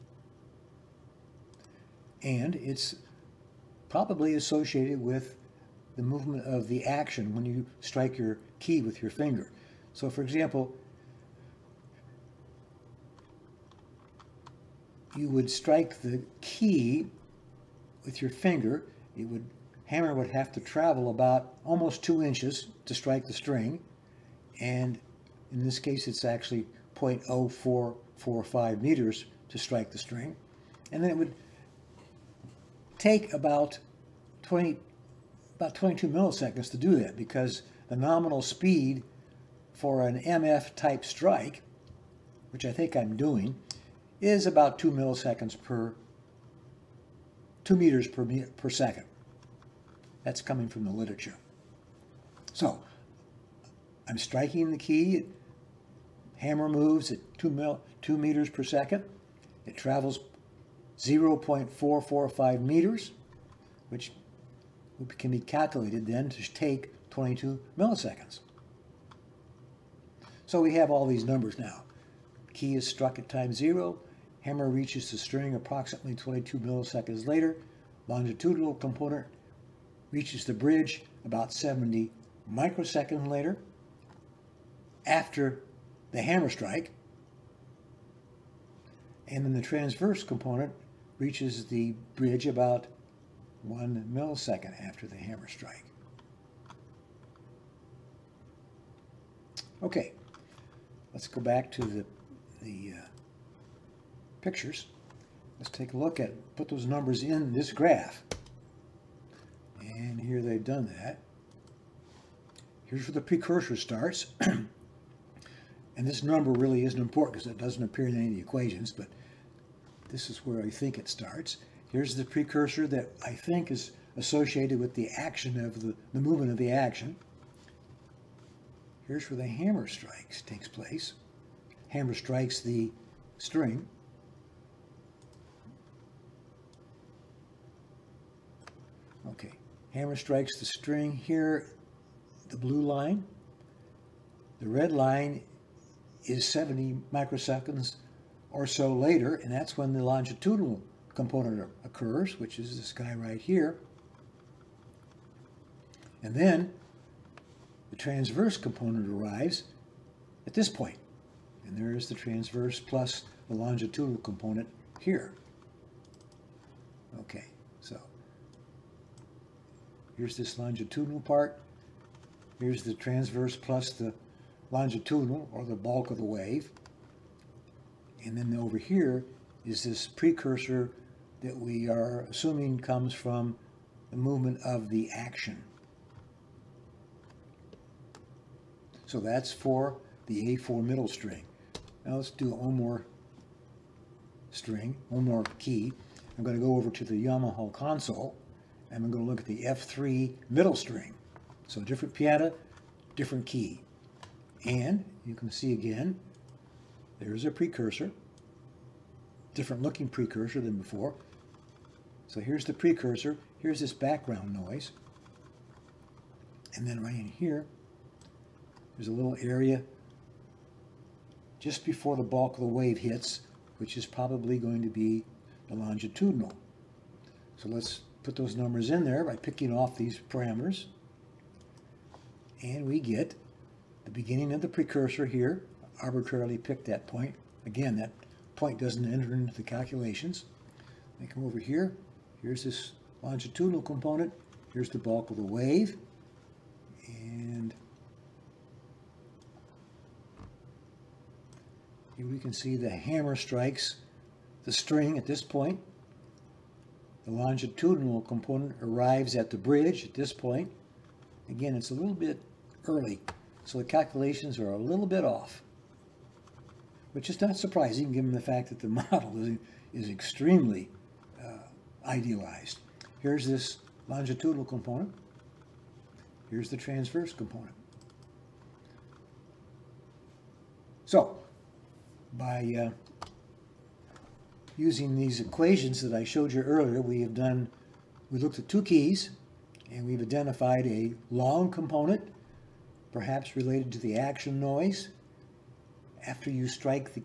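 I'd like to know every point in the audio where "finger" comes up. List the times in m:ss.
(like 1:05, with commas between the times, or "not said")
0:09, 0:18.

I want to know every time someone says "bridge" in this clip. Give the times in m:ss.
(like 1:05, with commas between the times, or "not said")
1:20, 1:32, 4:19.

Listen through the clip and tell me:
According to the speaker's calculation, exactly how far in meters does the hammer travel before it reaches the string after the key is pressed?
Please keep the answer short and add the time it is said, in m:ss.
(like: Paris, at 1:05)
0.0445 meters, at 0:26.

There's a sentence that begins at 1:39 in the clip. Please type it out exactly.
Okay, let's go back to the, the uh, pictures.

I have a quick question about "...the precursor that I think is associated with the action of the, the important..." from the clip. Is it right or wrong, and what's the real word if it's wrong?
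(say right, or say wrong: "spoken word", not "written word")
wrong: "movement", not "important".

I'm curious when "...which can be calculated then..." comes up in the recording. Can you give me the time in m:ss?
1:03.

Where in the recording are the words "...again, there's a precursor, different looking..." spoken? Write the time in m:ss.
3:25.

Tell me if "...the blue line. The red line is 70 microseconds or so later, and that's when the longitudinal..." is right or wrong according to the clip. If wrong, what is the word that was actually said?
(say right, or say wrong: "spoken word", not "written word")
right.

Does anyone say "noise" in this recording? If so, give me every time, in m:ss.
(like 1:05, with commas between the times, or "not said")
3:34, 4:54.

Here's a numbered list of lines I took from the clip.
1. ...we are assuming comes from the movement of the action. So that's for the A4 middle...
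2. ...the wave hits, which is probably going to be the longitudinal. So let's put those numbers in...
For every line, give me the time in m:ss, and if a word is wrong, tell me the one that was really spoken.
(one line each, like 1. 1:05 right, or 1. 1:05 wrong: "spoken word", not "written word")
1. 3:01 right
2. 3:42 right.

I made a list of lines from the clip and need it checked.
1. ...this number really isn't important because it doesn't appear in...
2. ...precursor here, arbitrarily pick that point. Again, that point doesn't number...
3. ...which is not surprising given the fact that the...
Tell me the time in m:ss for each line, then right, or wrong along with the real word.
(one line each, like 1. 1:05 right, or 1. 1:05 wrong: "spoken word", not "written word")
1. 1:55 right
2. 3:54 wrong: "enter", not "number"
3. 4:27 right.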